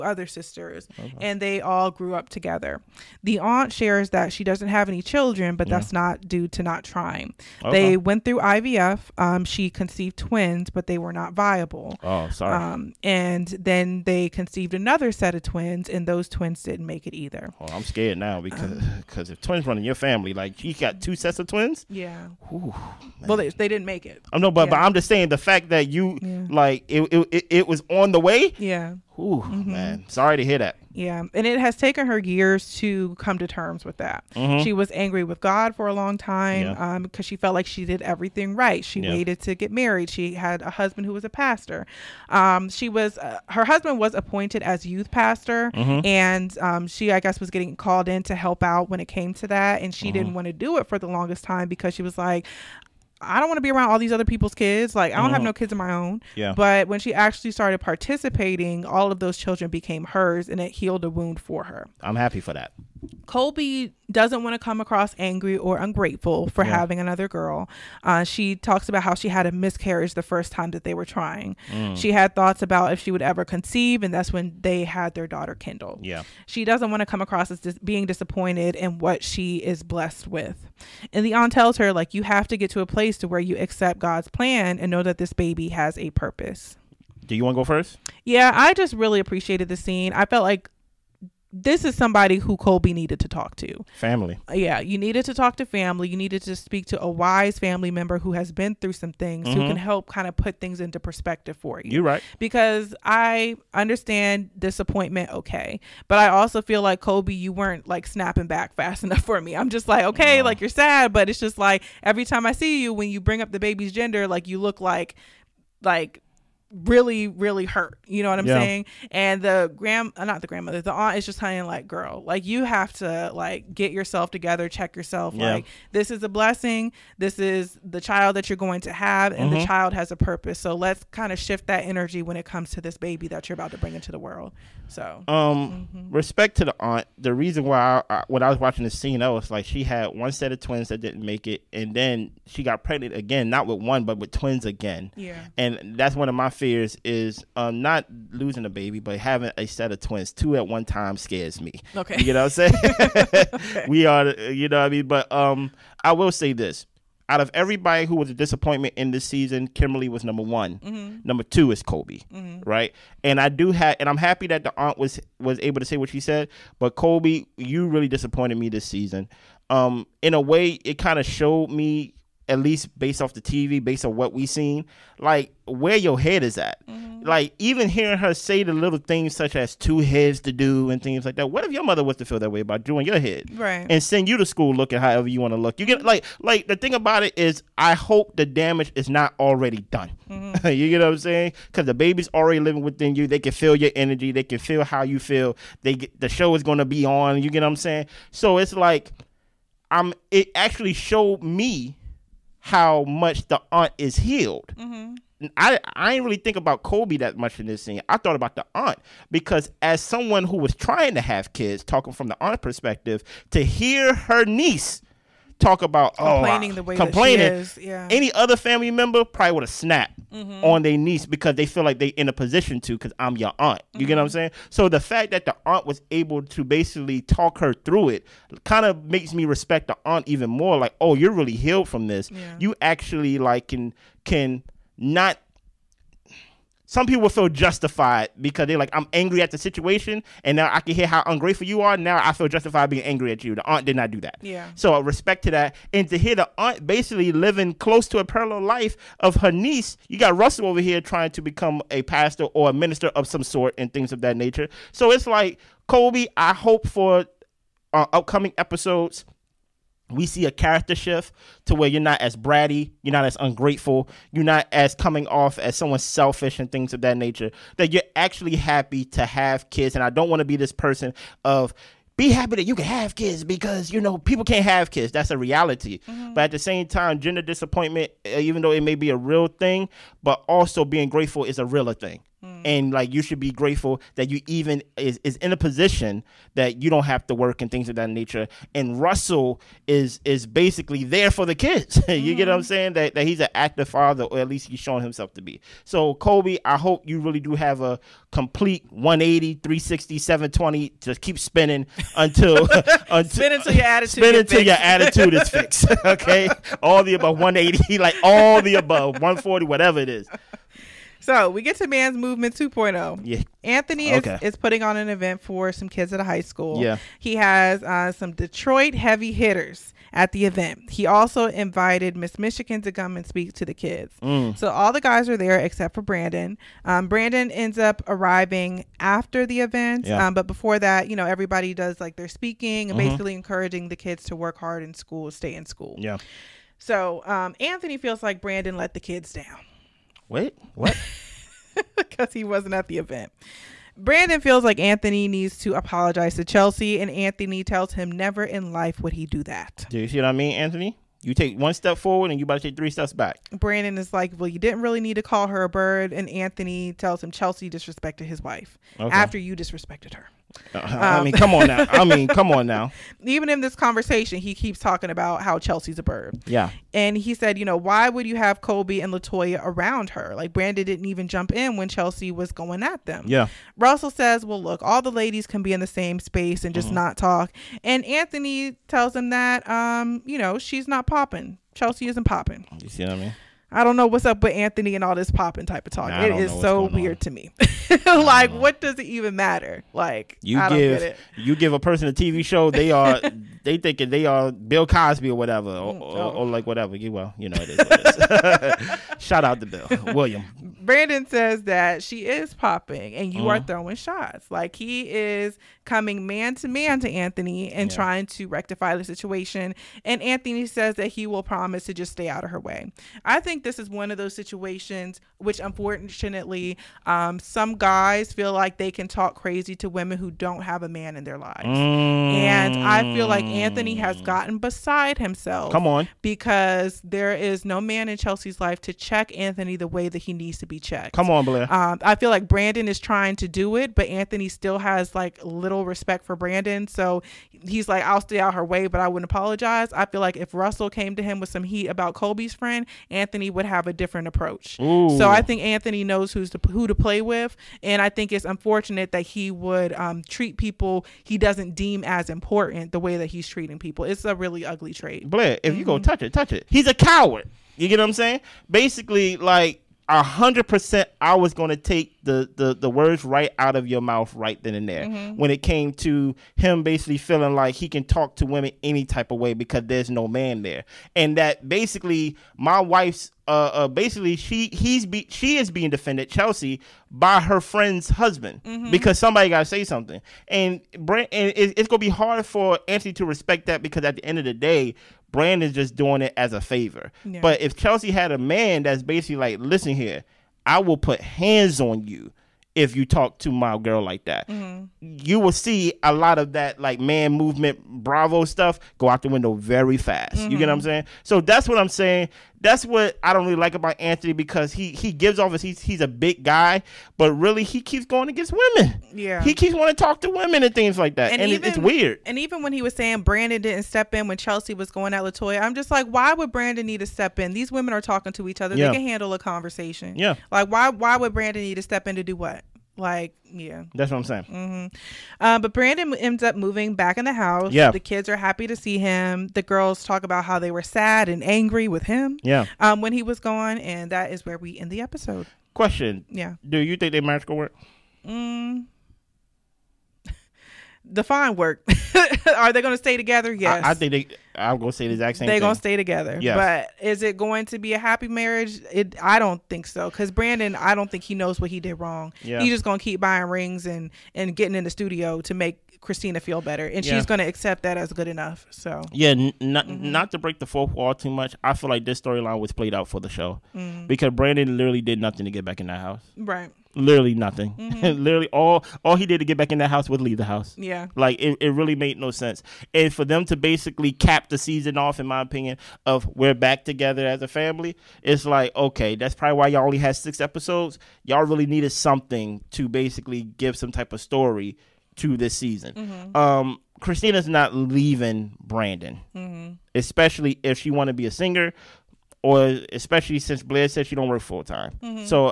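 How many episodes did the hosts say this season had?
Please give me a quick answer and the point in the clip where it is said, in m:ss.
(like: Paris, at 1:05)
6, at 9:40.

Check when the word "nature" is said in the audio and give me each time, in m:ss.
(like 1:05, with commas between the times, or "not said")
4:14, 4:27, 4:48.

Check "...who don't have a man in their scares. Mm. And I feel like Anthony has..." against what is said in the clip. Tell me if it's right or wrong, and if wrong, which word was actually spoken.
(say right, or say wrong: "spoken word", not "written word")
wrong: "lives", not "scares".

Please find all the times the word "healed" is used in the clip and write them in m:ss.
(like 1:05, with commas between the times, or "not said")
1:00, 3:24, 3:51.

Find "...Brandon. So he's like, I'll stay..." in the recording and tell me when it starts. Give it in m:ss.
7:16.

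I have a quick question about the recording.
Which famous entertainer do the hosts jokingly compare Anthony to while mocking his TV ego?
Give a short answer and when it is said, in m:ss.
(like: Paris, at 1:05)
Bill Cosby, at 6:34.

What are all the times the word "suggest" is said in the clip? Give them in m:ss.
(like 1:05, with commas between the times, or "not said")
not said.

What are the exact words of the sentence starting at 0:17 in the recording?
Oh, I'm scared now um, because because if twins run in your family, like you got two sets of twins.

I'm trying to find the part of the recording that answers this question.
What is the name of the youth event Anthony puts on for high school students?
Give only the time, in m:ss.
5:11.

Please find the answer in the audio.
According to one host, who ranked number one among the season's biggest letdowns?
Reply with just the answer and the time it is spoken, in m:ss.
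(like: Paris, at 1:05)
Kimberly, at 2:39.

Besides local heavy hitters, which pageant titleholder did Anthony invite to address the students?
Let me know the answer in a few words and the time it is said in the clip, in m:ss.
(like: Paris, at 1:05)
Miss Michigan, at 5:22.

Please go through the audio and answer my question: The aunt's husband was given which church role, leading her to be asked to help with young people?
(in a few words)
Youth pastor.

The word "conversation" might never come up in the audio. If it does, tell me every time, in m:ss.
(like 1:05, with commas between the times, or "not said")
6:03, 8:39.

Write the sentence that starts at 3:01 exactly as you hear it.
What if your mother was to feel that way about doing your head?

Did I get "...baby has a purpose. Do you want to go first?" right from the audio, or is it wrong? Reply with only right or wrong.
right.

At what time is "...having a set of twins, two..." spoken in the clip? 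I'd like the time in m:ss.
2:29.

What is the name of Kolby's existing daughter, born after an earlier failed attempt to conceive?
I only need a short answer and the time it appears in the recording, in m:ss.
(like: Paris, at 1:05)
Kendall, at 1:15.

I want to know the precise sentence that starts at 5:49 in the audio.
Do you see what I mean, Anthony?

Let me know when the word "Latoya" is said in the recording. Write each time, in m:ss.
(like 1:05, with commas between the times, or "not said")
6:09, 8:35.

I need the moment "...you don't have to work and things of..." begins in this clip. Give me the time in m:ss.
4:46.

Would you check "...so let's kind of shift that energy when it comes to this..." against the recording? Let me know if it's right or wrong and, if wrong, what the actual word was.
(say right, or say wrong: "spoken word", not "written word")
right.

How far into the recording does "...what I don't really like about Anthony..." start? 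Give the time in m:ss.
8:22.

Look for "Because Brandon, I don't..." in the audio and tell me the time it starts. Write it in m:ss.
9:10.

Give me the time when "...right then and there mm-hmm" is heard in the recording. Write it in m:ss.
7:44.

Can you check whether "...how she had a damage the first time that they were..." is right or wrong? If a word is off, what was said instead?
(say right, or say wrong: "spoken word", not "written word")
wrong: "miscarriage", not "damage".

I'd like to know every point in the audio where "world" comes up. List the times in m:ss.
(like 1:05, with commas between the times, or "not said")
2:14.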